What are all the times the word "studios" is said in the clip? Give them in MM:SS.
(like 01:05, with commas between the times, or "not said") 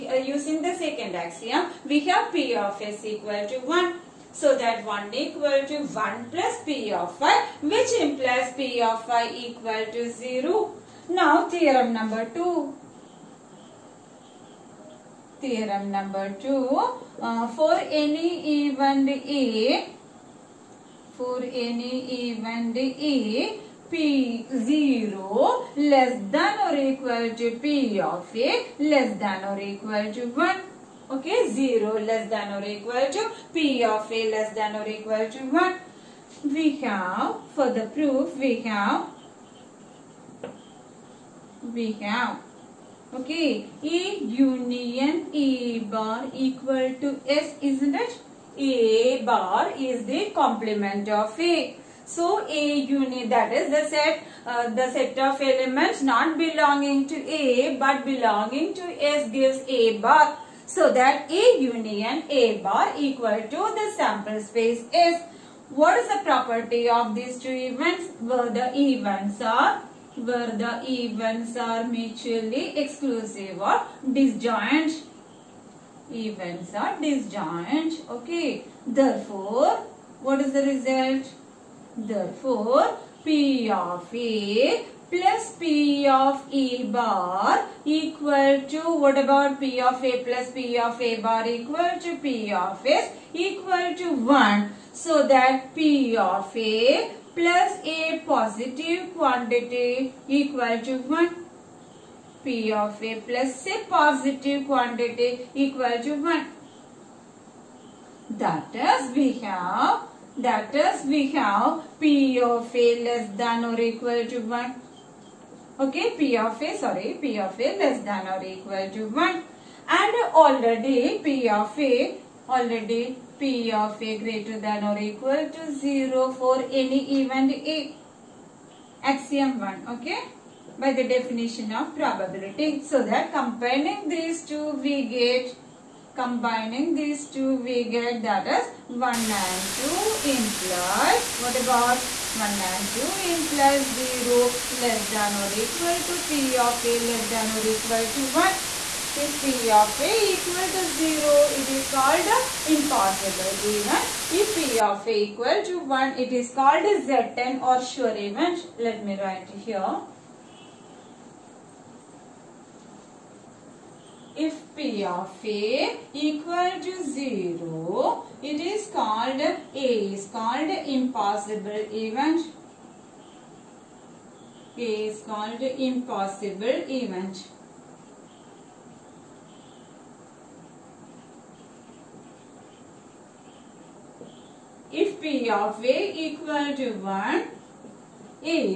not said.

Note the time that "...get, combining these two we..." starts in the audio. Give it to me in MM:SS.
02:15.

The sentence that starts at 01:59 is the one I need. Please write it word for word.
And already P of a, already P of A greater than or equal to 0 for any event A.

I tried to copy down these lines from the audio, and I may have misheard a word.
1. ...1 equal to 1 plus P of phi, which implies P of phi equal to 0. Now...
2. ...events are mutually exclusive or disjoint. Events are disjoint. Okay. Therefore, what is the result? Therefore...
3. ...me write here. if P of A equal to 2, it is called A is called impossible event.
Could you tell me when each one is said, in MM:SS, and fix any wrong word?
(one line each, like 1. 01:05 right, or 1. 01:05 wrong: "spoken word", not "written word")
1. 00:04 right
2. 01:10 right
3. 02:39 wrong: "0", not "2".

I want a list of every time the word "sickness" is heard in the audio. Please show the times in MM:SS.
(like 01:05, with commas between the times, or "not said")
not said.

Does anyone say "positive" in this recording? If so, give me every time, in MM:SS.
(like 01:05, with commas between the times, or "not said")
01:38, 01:43.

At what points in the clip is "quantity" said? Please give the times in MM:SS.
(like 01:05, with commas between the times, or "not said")
01:39, 01:44.